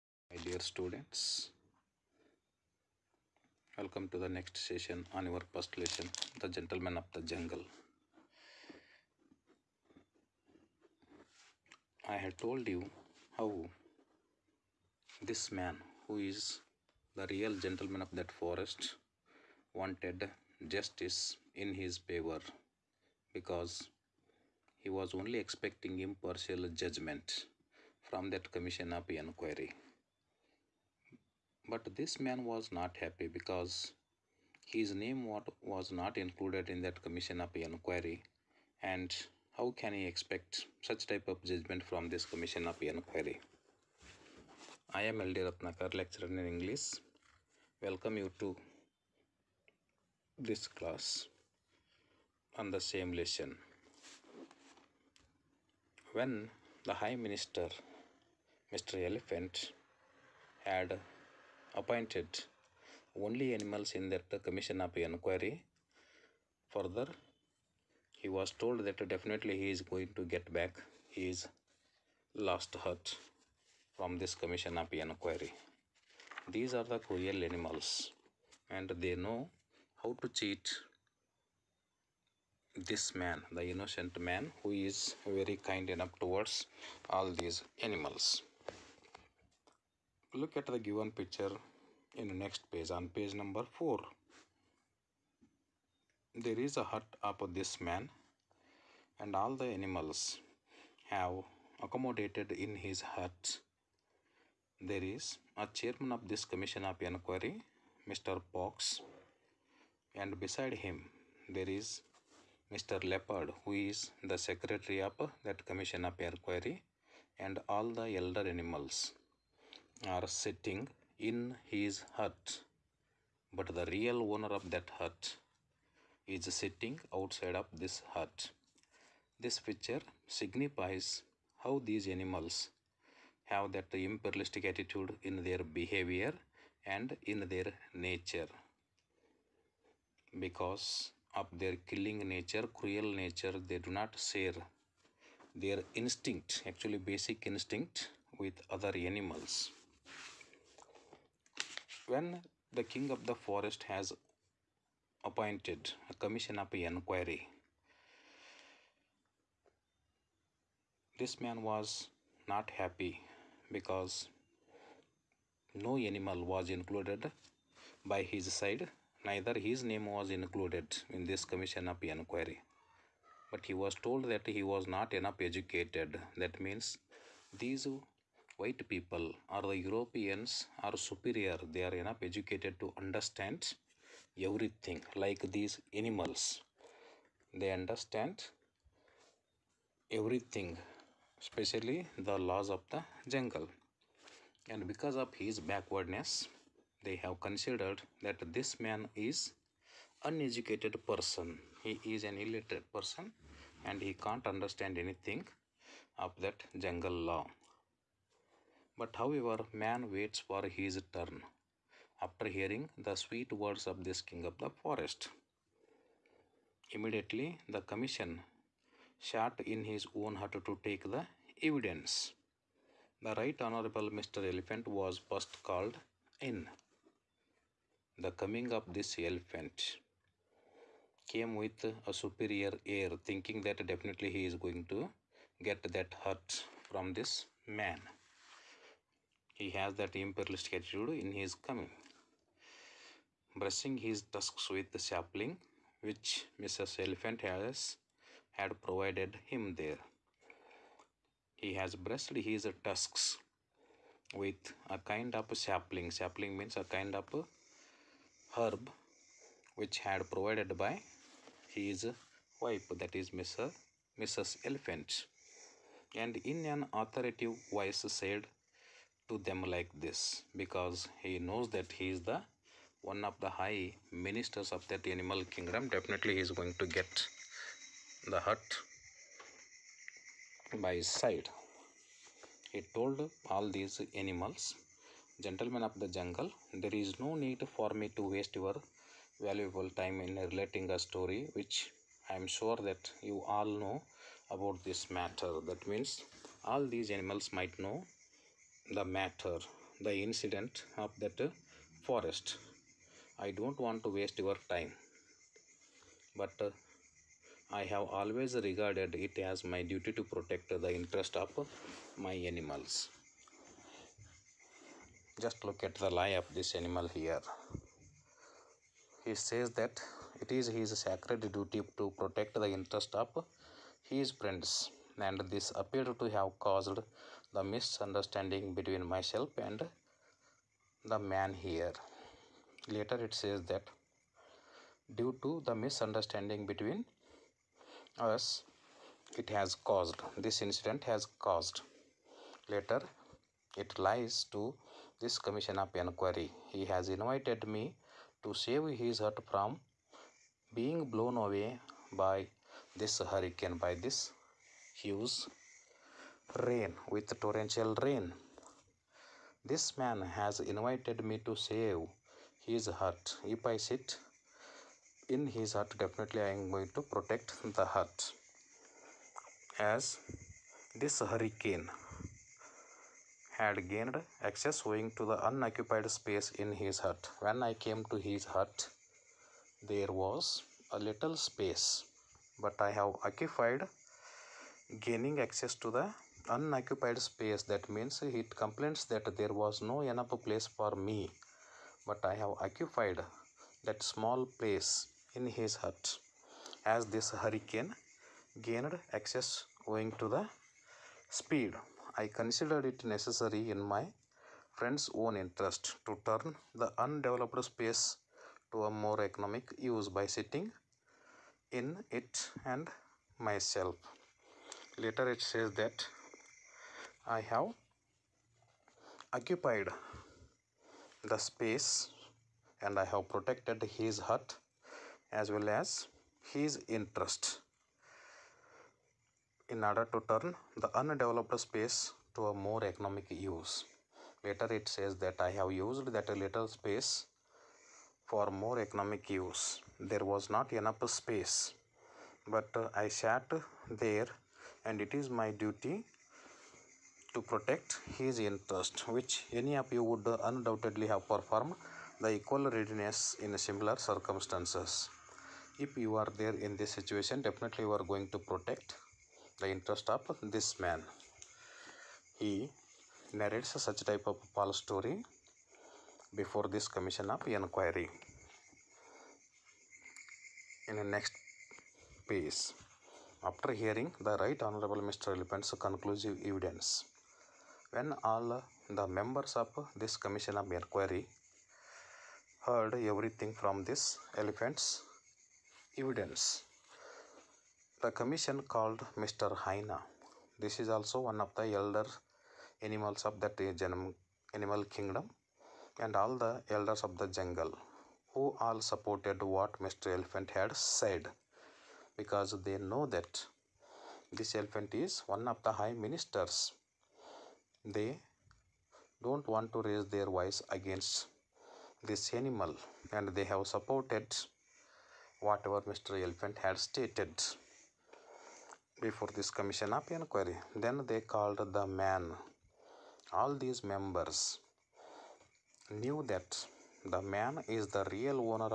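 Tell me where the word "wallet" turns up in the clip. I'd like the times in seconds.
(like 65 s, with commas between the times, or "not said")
not said.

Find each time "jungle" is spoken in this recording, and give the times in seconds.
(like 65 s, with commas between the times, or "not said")
7 s, 193 s, 206 s, 286 s, 497 s.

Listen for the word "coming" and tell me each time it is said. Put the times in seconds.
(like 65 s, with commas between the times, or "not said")
228 s, 241 s.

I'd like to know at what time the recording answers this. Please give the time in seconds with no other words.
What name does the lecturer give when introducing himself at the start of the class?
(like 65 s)
45 s.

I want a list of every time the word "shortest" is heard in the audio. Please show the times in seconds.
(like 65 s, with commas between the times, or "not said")
not said.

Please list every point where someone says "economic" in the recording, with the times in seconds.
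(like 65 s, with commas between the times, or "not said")
409 s, 432 s, 438 s.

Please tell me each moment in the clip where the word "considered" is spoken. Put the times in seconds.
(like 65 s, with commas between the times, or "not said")
197 s, 402 s.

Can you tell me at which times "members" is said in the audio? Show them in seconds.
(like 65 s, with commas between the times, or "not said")
479 s, 523 s.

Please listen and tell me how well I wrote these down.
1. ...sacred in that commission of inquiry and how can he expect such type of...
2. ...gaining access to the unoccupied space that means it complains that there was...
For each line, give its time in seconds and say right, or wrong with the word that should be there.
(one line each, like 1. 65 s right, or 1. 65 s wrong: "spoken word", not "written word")
1. 36 s wrong: "included", not "sacred"
2. 384 s right.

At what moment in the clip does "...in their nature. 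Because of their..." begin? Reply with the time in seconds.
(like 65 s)
137 s.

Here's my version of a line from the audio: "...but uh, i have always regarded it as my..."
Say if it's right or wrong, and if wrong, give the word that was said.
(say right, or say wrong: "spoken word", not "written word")
right.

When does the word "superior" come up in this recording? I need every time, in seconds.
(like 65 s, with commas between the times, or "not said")
180 s, 232 s.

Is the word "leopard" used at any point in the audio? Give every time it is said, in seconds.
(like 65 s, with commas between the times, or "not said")
113 s.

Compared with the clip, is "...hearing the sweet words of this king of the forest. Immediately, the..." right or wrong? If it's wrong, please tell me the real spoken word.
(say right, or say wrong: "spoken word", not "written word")
right.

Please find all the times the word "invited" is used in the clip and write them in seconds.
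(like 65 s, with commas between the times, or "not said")
347 s, 360 s.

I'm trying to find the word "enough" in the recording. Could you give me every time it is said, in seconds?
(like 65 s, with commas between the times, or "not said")
85 s, 175 s, 181 s, 390 s, 440 s.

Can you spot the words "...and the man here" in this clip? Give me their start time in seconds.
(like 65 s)
329 s.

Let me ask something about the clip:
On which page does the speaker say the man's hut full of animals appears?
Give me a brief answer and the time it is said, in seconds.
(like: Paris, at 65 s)
4, at 93 s.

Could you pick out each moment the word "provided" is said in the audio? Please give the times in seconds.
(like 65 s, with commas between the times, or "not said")
248 s, 260 s.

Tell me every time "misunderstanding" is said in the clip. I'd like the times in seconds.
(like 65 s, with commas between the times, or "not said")
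327 s, 335 s.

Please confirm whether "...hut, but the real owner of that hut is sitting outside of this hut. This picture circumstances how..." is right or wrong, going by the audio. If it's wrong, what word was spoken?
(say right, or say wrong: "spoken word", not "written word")
wrong: "signifies", not "circumstances".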